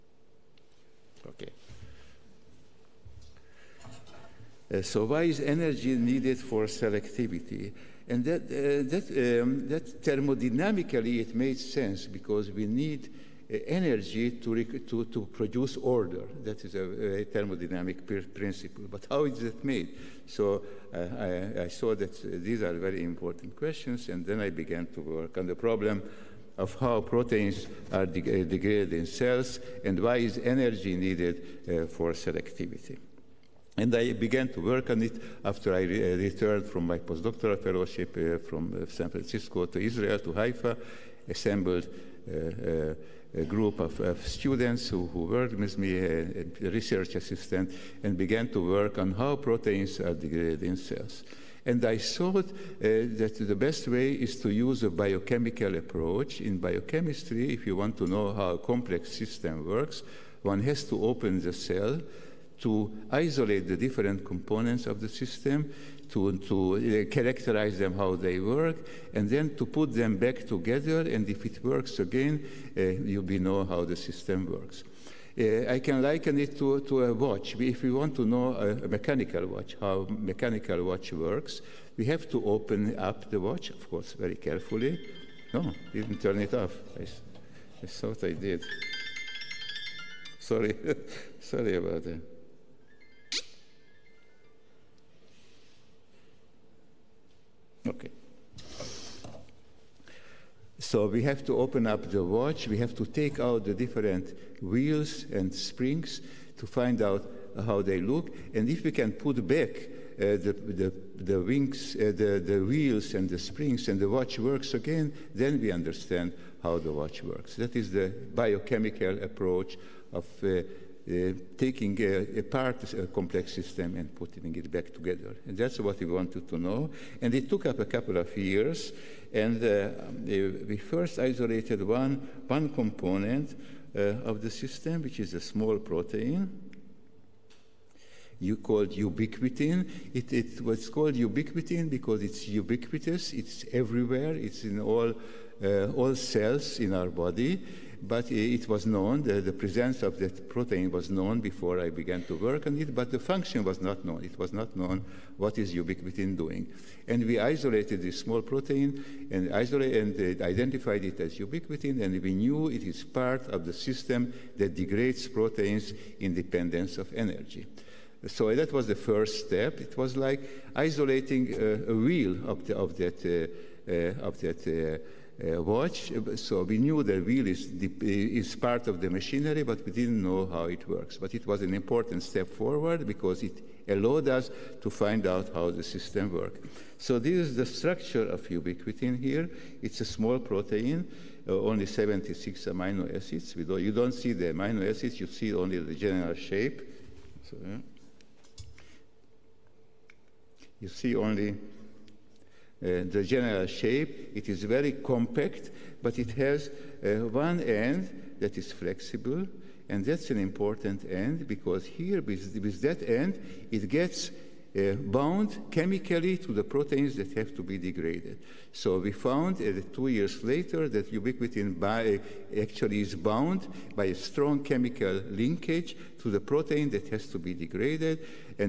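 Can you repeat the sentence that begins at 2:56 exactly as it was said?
So we knew the wheel is, is part of the machinery, but we didn't know how it works.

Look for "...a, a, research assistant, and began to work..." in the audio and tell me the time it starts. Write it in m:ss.
0:45.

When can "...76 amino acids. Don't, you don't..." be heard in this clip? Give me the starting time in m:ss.
3:11.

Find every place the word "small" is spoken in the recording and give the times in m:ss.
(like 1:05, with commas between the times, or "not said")
2:15, 2:38, 3:10.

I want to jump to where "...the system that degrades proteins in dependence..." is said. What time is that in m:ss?
2:43.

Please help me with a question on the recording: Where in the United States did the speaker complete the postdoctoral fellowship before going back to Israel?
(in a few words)
San Francisco.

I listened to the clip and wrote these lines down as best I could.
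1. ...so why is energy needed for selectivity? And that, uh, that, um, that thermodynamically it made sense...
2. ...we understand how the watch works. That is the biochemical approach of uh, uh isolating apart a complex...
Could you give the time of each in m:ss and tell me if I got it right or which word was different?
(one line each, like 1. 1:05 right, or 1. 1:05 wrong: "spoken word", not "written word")
1. 0:04 right
2. 1:55 wrong: "taking", not "isolating".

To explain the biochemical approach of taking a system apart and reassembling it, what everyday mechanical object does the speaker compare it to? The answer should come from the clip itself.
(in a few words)
A watch.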